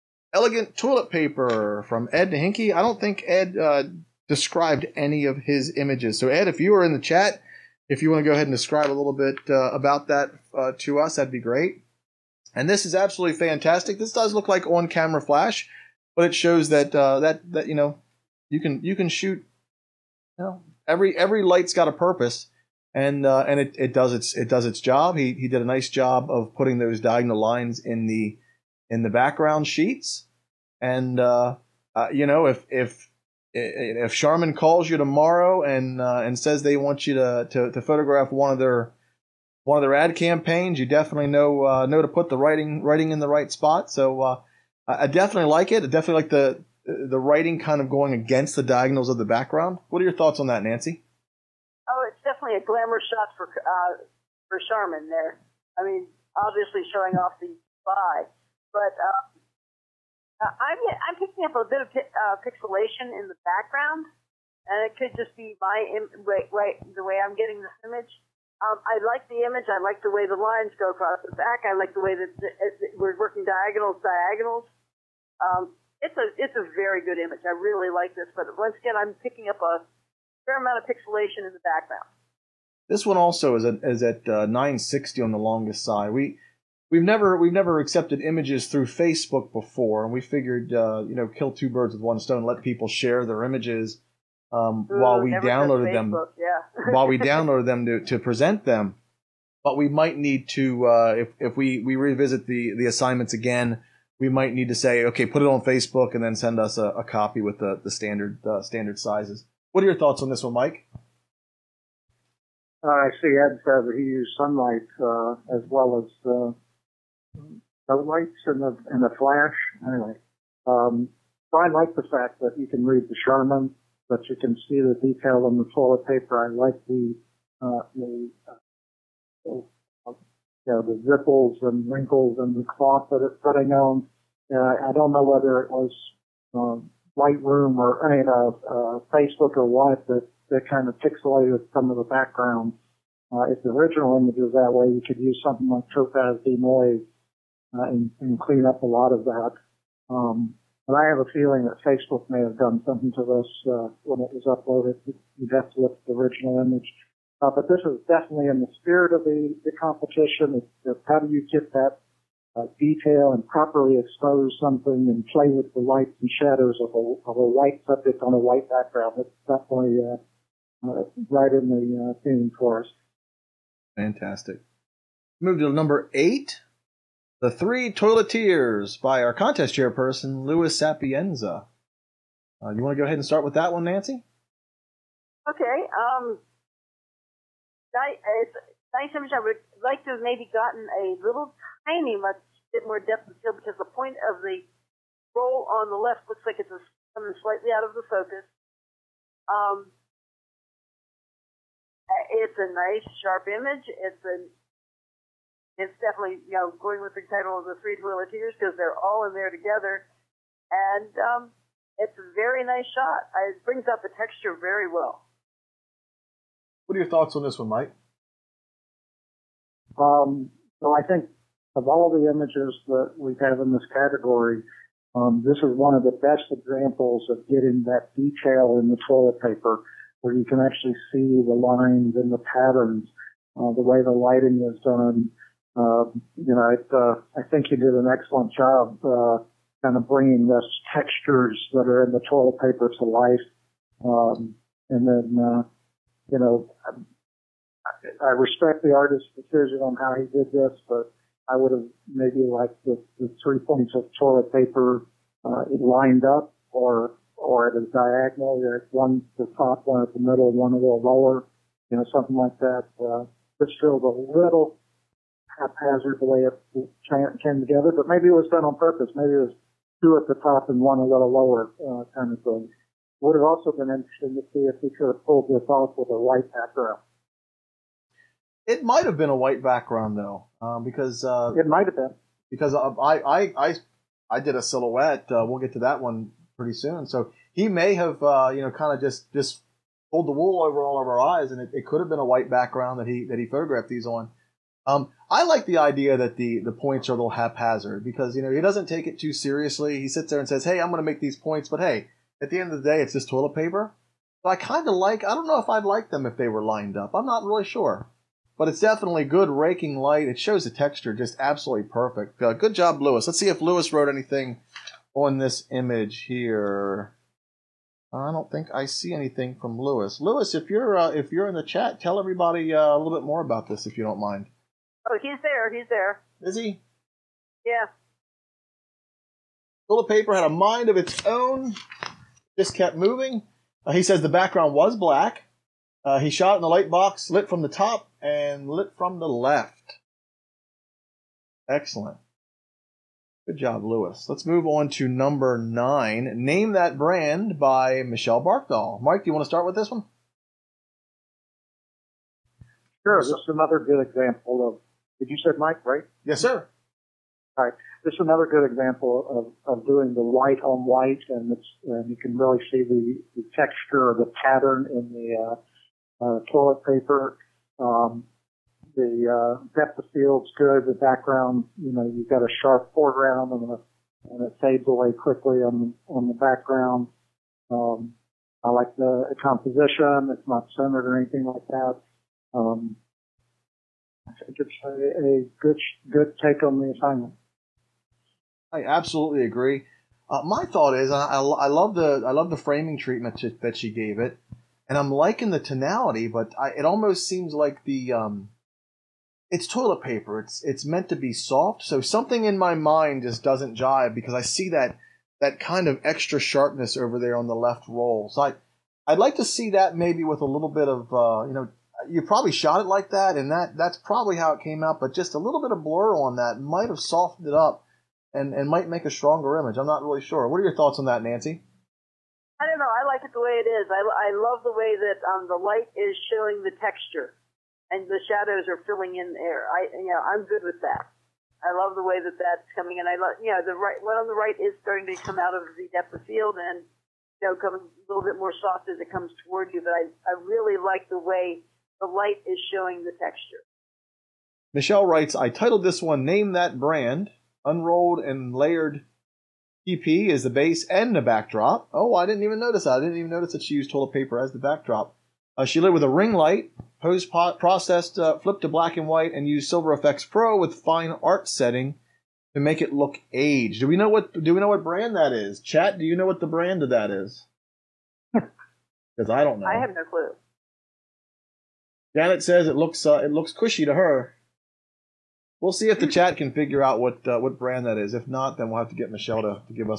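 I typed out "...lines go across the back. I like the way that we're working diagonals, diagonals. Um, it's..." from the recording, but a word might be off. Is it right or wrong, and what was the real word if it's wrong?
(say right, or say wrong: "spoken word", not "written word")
right.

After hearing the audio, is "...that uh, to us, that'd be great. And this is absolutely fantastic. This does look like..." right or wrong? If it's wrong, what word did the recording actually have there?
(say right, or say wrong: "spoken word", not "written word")
right.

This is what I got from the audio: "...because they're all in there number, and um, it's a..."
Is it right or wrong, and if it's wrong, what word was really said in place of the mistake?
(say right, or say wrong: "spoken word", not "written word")
wrong: "together", not "number".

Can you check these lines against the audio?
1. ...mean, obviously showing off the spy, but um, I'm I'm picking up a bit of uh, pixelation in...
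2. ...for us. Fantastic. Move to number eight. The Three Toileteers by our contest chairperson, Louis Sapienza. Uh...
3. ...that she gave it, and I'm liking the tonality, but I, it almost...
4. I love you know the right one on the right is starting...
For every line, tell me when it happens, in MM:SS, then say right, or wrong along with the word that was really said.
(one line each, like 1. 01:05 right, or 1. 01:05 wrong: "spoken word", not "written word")
1. 00:55 right
2. 02:52 right
3. 06:33 right
4. 07:13 right.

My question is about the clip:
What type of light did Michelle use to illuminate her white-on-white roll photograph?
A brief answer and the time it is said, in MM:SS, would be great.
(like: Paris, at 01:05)
Ring light, at 07:36.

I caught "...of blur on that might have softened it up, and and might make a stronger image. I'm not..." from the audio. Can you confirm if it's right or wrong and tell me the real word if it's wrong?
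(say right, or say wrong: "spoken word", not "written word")
right.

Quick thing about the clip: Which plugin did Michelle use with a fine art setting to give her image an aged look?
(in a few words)
Silver Efex Pro.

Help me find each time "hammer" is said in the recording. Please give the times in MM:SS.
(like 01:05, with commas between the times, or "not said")
not said.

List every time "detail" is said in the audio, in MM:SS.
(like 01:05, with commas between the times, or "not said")
02:05, 02:42, 03:48.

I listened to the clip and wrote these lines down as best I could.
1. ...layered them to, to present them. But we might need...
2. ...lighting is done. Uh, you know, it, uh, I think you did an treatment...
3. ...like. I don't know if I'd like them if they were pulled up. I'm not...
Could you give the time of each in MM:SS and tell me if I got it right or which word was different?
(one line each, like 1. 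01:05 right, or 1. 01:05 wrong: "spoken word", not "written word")
1. 01:37 wrong: "downloaded", not "layered"
2. 03:54 wrong: "excellent", not "treatment"
3. 05:04 wrong: "lined", not "pulled".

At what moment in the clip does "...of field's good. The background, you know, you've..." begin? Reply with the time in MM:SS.
06:09.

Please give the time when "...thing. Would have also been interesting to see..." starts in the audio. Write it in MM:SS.
04:32.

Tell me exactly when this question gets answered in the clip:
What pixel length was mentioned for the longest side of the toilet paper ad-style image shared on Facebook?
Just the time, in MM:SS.
01:24.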